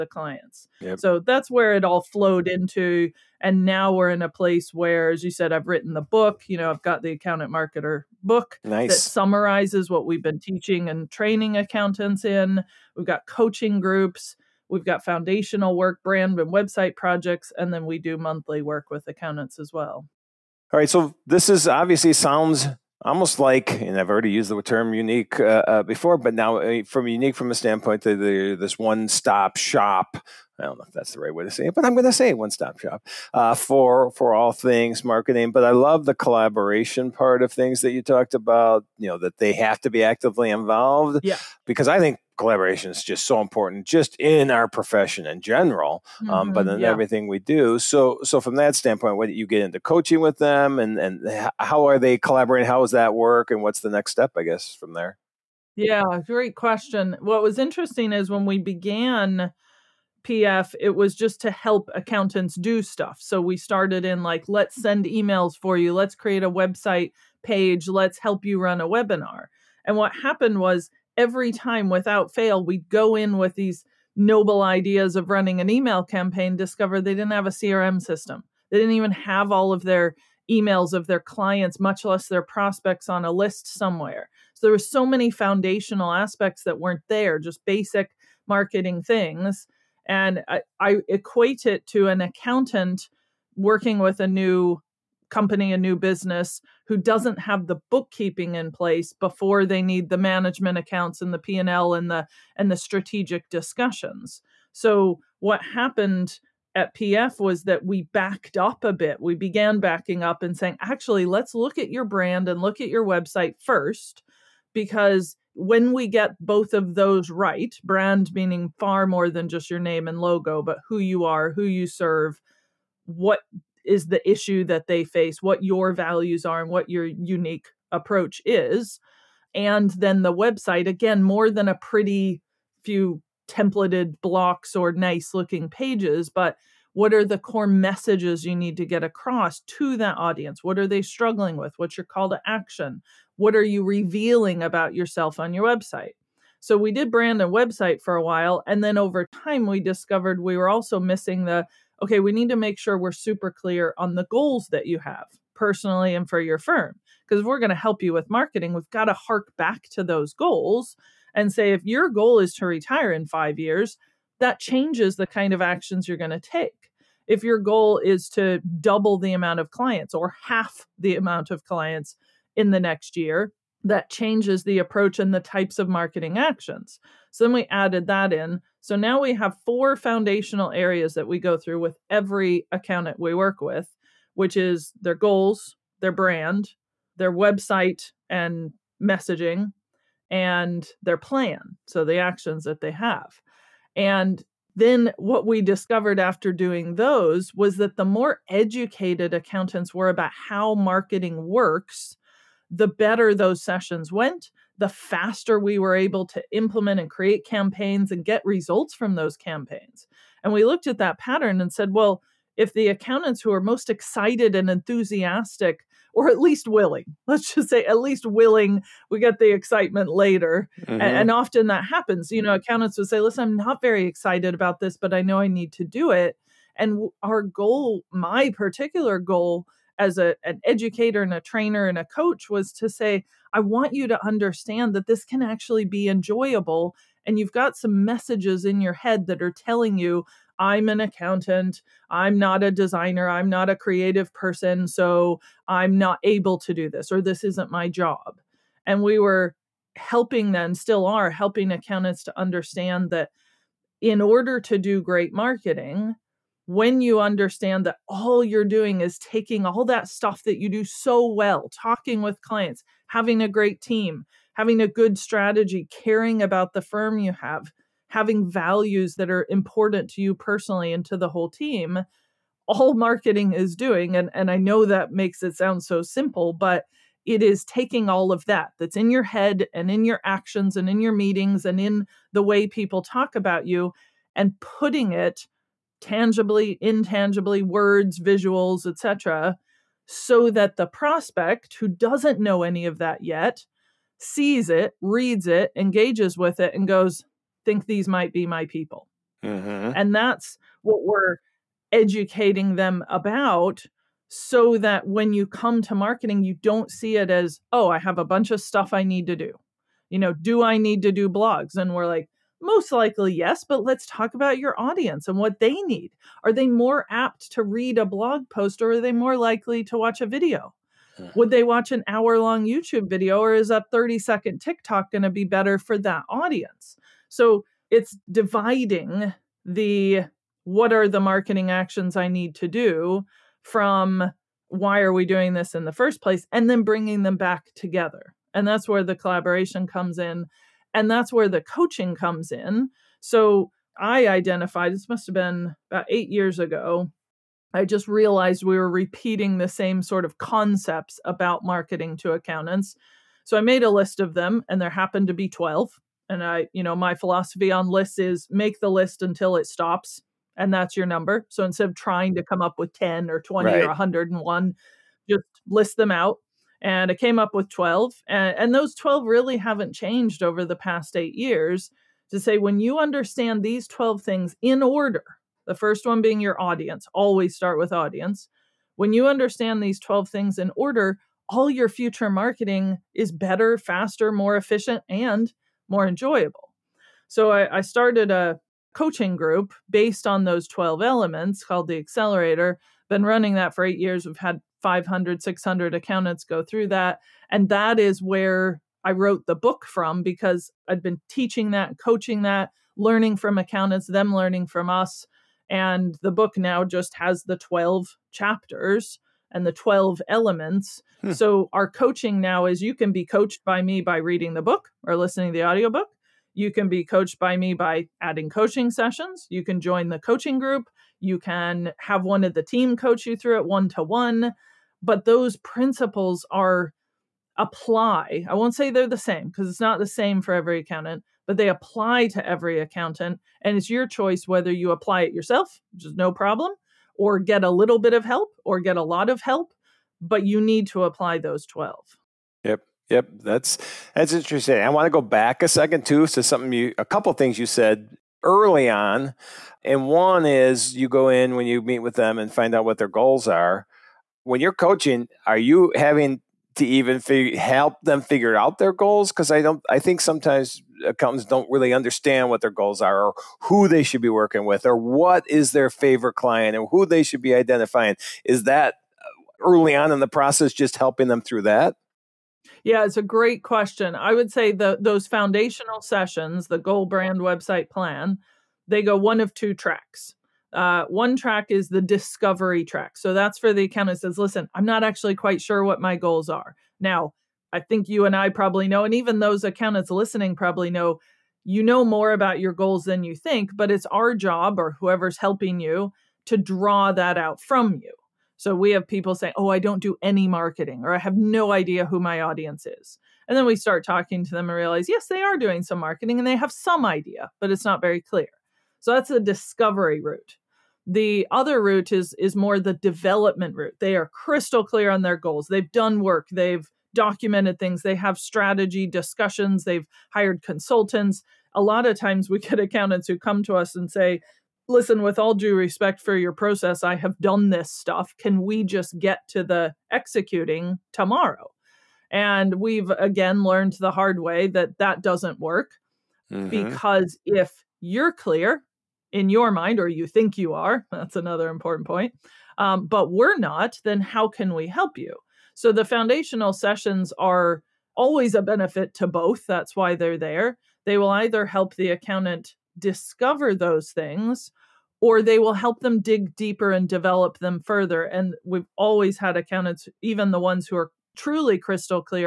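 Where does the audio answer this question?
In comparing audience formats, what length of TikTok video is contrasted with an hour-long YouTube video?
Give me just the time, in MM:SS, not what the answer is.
05:23.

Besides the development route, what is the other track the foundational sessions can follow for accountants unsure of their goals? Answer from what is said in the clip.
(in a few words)
Discovery track.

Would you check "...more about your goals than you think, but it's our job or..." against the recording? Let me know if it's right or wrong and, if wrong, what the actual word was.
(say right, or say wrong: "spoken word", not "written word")
right.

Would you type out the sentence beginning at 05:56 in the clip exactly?
And I, you know, my philosophy on lists is make the list until it stops, and that's your number.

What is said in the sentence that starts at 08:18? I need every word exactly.
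So we have people say, Oh, I don't do any marketing, or I have no idea who my audience is.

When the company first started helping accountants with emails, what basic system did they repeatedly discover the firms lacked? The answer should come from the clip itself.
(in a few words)
CRM system.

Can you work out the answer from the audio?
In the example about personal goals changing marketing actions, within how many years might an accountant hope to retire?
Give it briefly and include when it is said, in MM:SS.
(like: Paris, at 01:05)
5, at 02:43.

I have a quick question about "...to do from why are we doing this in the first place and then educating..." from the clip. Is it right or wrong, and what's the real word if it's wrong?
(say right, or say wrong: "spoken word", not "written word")
wrong: "bringing", not "educating".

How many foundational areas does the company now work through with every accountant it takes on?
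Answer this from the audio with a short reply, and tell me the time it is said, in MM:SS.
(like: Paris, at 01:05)
4, at 02:59.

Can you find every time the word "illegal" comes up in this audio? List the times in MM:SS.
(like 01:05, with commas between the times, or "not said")
not said.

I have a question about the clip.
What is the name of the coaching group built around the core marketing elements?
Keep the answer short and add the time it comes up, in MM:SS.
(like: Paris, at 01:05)
The Accelerator, at 06:31.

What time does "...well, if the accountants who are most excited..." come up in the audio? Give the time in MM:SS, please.
03:31.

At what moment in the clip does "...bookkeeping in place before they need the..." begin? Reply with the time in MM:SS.
01:37.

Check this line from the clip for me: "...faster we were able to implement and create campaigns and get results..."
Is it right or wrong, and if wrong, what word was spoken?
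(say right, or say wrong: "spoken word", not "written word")
right.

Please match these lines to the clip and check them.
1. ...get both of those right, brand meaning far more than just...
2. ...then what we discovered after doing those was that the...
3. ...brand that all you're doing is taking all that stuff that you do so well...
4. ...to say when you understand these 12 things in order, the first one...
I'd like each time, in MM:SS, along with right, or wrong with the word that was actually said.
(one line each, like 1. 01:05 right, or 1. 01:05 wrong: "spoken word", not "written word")
1. 01:56 right
2. 03:14 right
3. 04:17 wrong: "understand", not "brand"
4. 06:12 right.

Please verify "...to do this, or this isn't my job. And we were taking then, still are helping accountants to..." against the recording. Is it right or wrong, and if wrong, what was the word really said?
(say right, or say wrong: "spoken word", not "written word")
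wrong: "helping", not "taking".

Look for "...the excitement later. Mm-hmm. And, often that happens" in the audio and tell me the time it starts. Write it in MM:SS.
03:39.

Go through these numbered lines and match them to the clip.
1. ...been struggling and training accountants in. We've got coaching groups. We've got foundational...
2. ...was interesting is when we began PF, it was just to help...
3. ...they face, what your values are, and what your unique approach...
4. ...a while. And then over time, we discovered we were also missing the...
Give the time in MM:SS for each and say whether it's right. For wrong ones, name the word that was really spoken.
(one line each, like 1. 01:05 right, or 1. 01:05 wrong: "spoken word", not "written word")
1. 00:10 wrong: "teaching", not "struggling"
2. 00:57 right
3. 02:04 right
4. 02:28 right.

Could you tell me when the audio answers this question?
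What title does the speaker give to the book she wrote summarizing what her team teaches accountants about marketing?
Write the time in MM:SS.
00:07.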